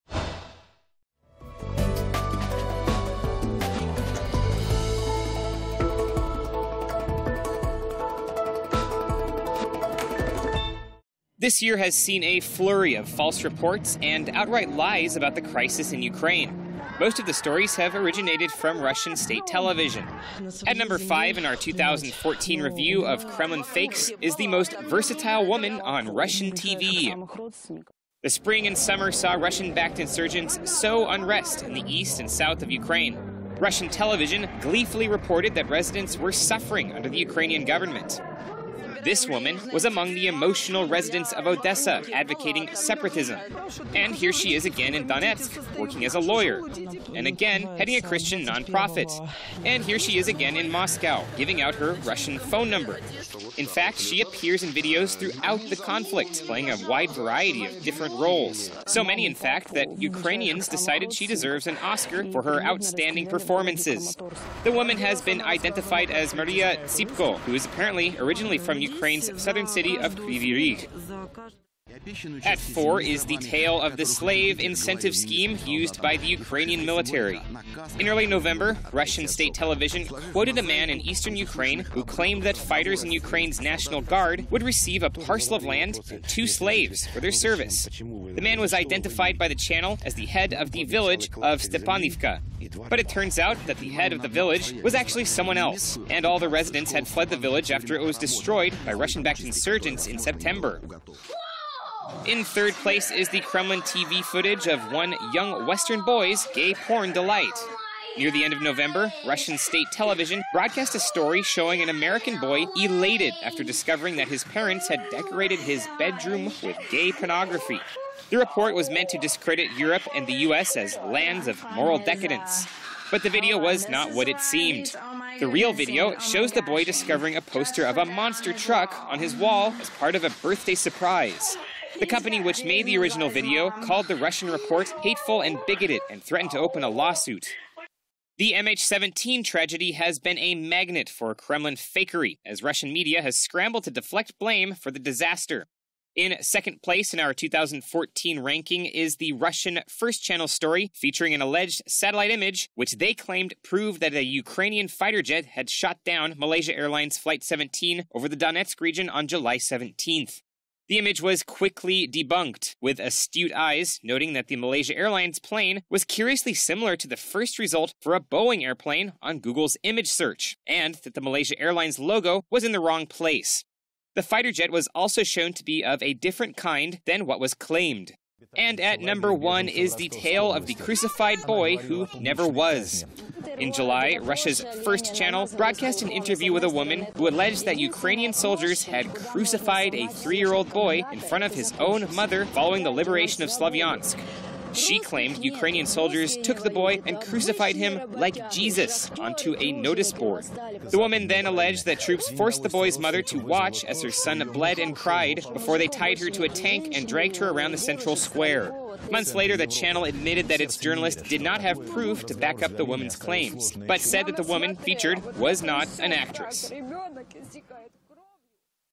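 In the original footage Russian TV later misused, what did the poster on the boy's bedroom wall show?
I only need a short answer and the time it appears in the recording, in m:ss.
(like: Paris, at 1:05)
A monster truck, at 2:07.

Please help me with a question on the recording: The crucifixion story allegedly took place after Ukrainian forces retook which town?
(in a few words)
Slavyansk.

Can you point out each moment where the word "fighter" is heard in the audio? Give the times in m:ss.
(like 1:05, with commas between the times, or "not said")
1:22, 2:34, 2:54.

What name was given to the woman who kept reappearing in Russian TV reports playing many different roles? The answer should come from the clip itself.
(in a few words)
Maria Tsipko.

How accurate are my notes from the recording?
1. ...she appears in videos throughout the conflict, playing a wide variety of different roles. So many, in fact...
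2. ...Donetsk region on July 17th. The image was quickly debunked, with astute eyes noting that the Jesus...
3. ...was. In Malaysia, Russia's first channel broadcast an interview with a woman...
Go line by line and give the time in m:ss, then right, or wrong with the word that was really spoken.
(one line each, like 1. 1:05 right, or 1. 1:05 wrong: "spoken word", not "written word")
1. 0:53 right
2. 2:38 wrong: "Malaysia", not "Jesus"
3. 3:02 wrong: "July", not "Malaysia".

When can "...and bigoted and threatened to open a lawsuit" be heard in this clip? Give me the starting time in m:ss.
2:15.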